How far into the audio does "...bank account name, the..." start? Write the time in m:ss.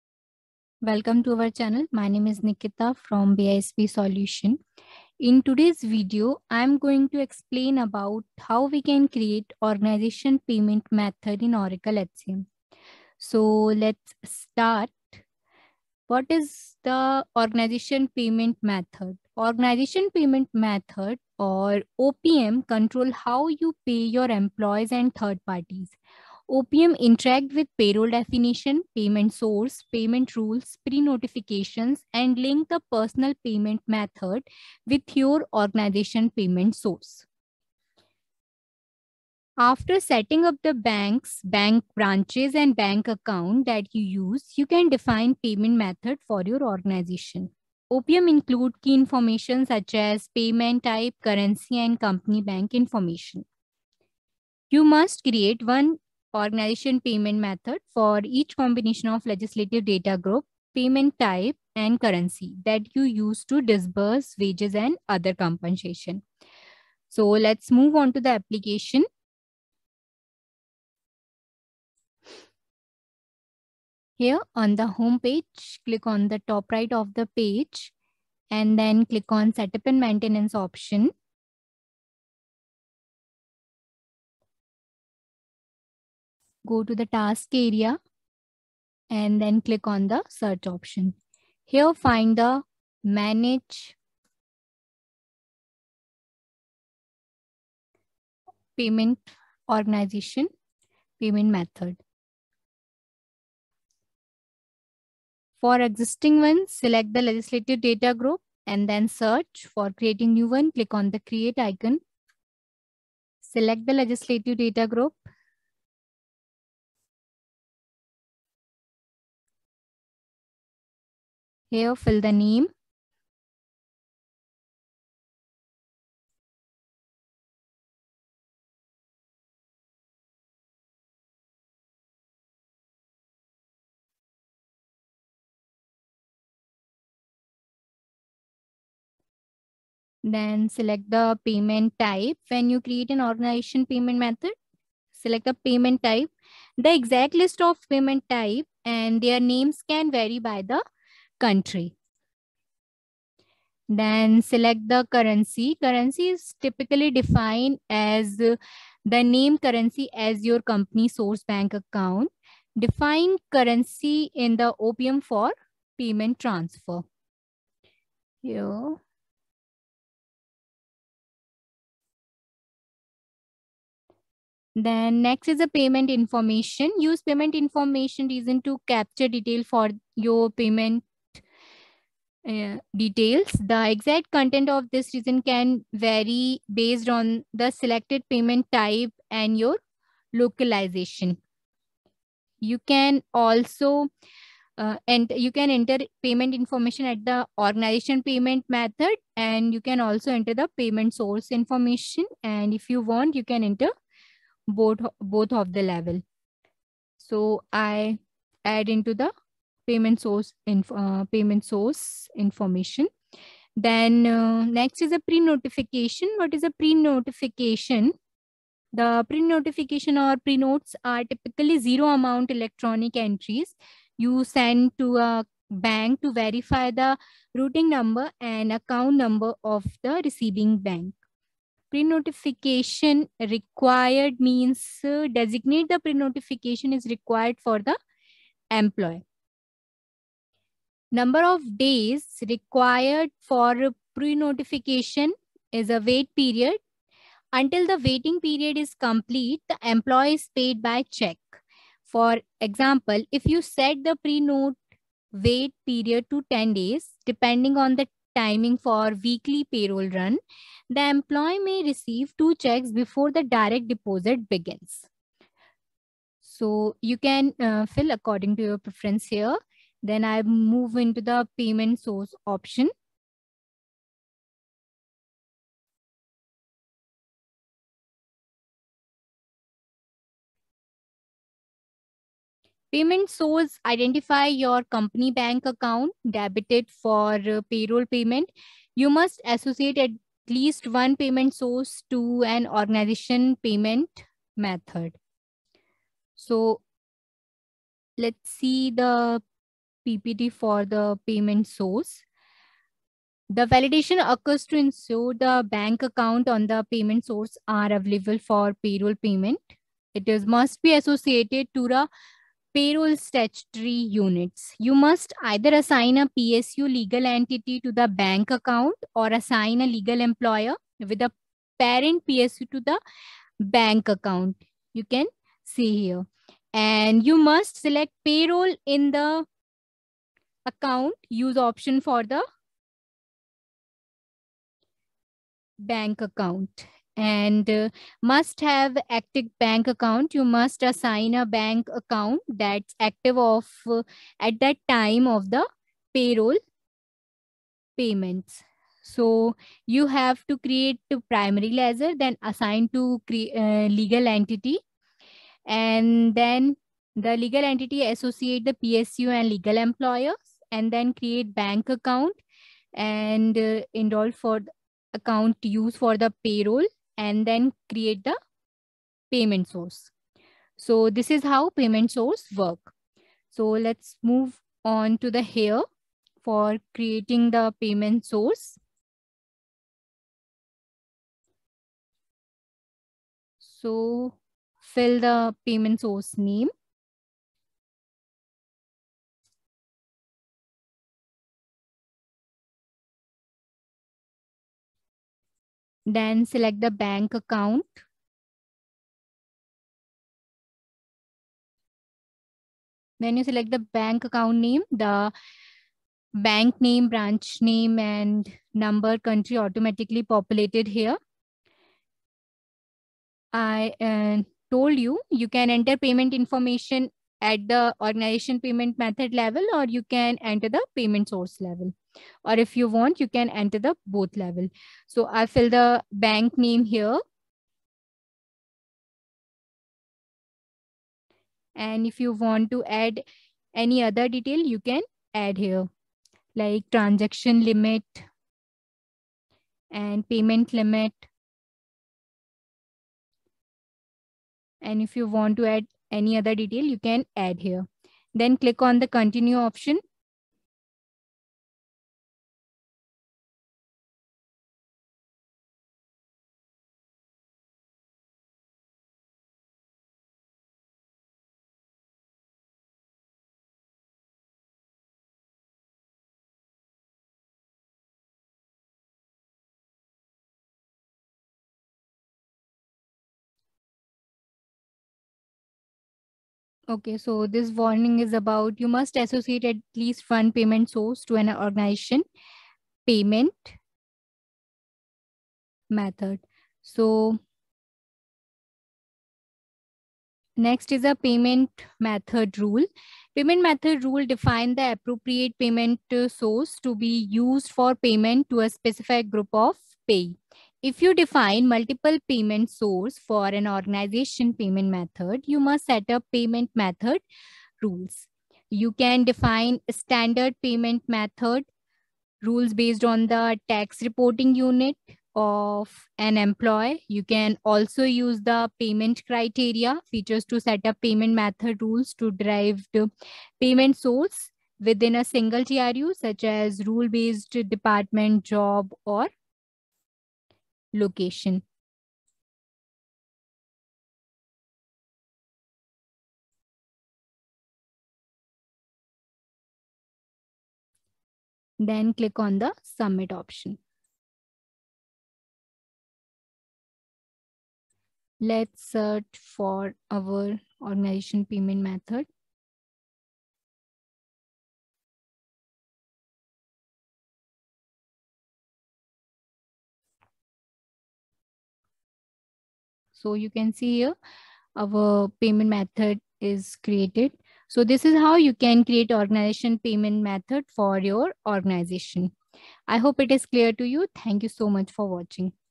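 6:43.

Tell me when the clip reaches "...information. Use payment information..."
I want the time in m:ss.
2:56.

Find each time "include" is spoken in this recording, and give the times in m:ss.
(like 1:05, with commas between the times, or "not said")
0:48.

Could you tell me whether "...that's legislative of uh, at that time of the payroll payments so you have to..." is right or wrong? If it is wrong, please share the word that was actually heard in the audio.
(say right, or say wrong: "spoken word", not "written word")
wrong: "active", not "legislative".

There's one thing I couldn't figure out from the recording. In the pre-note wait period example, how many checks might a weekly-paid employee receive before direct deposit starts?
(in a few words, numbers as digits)
2.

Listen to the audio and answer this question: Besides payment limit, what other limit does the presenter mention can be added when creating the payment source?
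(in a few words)
Transaction limit.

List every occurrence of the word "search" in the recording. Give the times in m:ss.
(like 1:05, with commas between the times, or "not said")
1:30, 1:49, 9:08.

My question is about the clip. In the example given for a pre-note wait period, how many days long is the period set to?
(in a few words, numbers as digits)
10.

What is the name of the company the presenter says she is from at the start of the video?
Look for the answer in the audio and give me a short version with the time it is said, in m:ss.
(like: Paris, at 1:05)
BISP Solution, at 0:03.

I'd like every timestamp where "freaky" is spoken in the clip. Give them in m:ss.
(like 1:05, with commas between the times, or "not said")
not said.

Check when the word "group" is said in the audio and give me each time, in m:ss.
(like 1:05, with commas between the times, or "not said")
1:00, 1:48, 1:54, 8:19.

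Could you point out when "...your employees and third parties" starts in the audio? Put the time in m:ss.
0:24.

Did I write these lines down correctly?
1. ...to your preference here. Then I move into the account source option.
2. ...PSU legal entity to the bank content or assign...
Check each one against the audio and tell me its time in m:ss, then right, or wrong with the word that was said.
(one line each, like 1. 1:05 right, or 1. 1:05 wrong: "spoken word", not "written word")
1. 4:28 wrong: "payment", not "account"
2. 5:16 wrong: "account", not "content".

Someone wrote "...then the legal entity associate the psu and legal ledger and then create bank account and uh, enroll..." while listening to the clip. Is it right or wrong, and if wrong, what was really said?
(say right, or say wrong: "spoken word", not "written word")
wrong: "employer", not "ledger".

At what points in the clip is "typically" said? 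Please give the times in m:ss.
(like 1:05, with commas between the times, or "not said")
2:36, 3:41.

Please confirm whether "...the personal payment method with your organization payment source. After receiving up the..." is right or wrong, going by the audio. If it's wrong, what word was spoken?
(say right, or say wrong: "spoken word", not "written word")
wrong: "setting", not "receiving".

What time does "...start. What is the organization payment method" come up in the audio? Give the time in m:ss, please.
0:14.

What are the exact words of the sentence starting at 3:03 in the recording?
The exact content of this reason can vary based on the selected payment type and your localization.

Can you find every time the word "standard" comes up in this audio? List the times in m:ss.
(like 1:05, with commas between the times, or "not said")
8:29.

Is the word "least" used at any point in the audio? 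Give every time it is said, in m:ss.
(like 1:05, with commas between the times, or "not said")
4:50, 7:59.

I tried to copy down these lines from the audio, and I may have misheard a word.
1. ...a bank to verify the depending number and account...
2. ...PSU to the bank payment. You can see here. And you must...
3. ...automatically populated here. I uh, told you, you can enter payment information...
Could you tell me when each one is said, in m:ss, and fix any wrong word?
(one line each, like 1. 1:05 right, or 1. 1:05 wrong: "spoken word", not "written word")
1. 3:45 wrong: "routing", not "depending"
2. 5:22 wrong: "account", not "payment"
3. 6:49 right.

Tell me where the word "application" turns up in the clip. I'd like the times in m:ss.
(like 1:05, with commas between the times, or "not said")
1:08.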